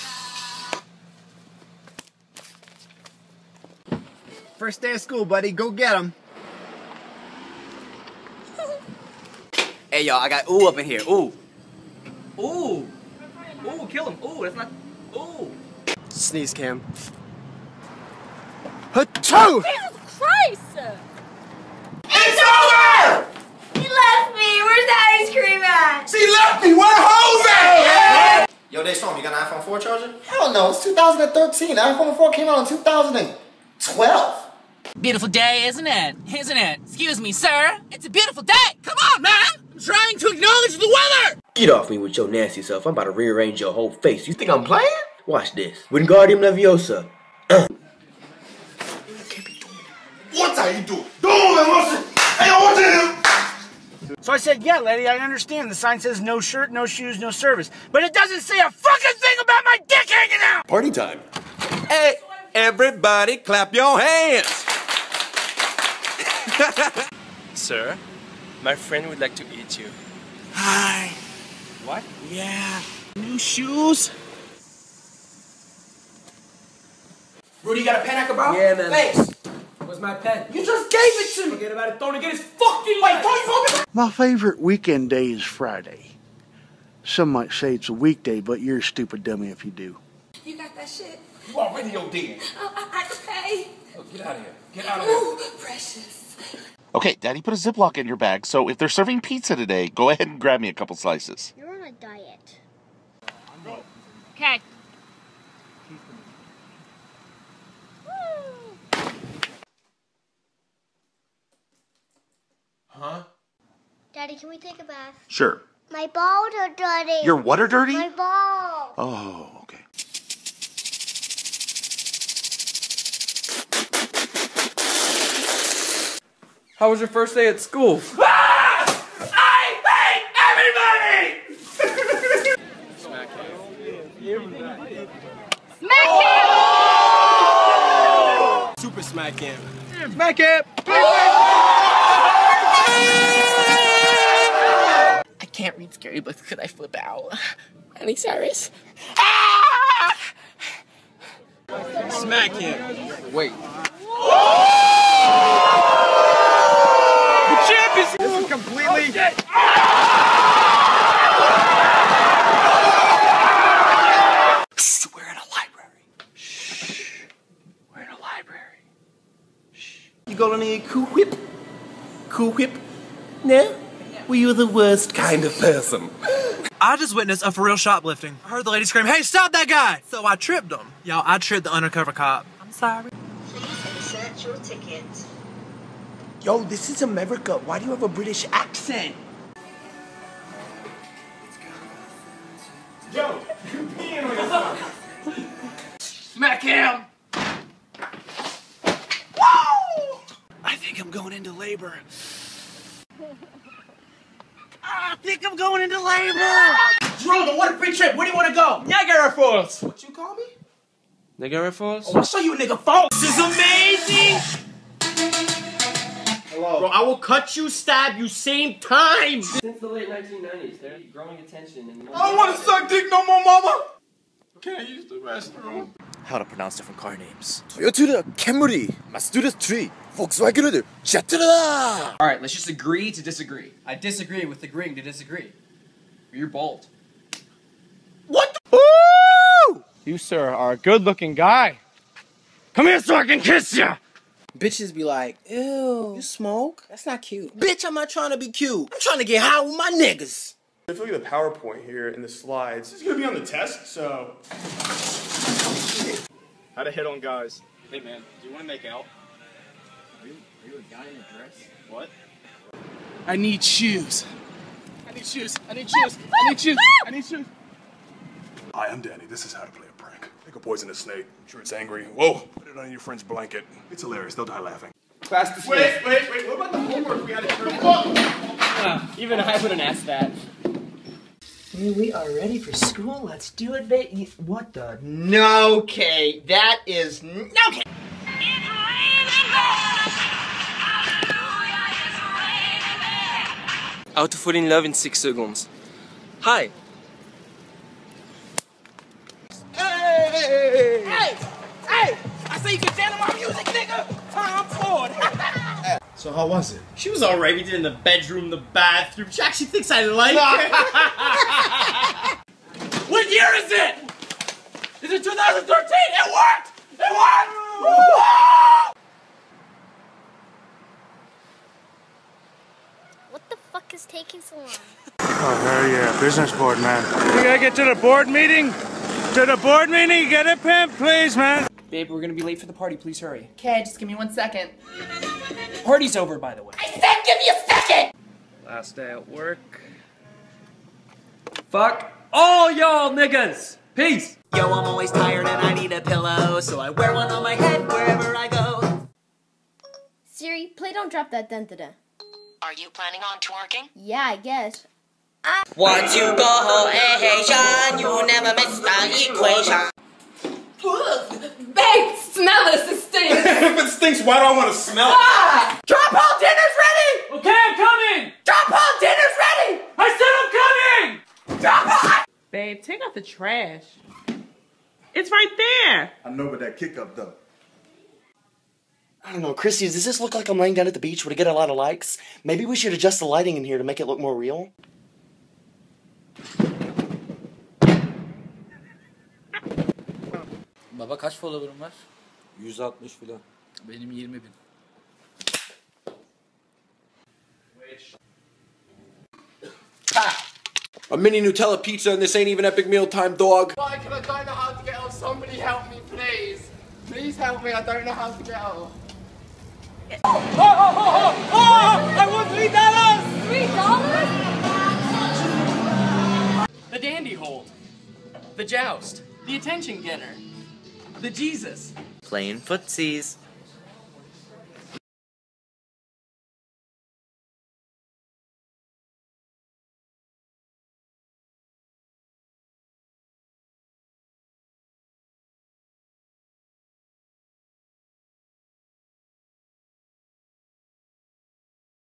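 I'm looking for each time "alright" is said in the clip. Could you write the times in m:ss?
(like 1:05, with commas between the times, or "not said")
5:07.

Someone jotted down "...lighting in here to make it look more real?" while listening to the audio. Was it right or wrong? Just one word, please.
right.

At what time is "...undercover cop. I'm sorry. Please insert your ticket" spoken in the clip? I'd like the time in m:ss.
3:01.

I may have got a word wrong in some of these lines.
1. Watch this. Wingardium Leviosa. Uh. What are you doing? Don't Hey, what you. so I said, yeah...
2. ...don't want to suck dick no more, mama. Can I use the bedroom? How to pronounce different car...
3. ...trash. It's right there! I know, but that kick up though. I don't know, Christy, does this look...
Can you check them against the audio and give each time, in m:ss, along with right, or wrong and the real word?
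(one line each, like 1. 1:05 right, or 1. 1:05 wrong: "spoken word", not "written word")
1. 0:45 right
2. 3:42 wrong: "restroom", not "bedroom"
3. 6:13 right.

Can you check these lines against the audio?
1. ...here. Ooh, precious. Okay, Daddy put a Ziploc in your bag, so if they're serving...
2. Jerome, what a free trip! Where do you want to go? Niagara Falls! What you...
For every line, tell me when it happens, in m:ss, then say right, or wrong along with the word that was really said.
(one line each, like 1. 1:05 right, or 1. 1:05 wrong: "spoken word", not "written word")
1. 1:35 right
2. 3:27 right.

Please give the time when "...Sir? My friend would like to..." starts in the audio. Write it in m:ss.
1:07.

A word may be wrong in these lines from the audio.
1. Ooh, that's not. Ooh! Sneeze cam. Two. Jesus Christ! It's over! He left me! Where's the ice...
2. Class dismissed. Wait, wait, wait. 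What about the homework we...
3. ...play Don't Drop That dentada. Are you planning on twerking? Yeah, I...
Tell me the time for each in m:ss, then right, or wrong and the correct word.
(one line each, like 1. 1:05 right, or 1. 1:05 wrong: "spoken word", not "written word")
1. 0:14 right
2. 4:35 right
3. 5:50 right.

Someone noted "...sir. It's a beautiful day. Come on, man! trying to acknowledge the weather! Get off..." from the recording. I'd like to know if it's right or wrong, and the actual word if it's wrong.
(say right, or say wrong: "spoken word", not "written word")
right.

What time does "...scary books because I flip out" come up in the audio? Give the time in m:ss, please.
2:25.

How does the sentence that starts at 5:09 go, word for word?
She actually thinks I like it.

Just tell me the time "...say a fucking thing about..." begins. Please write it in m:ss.
0:58.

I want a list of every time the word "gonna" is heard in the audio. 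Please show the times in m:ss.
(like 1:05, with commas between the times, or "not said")
4:13, 5:32.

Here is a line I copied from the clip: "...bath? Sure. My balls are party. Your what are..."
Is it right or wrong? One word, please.
wrong.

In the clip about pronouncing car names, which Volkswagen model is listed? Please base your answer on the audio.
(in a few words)
Jetta.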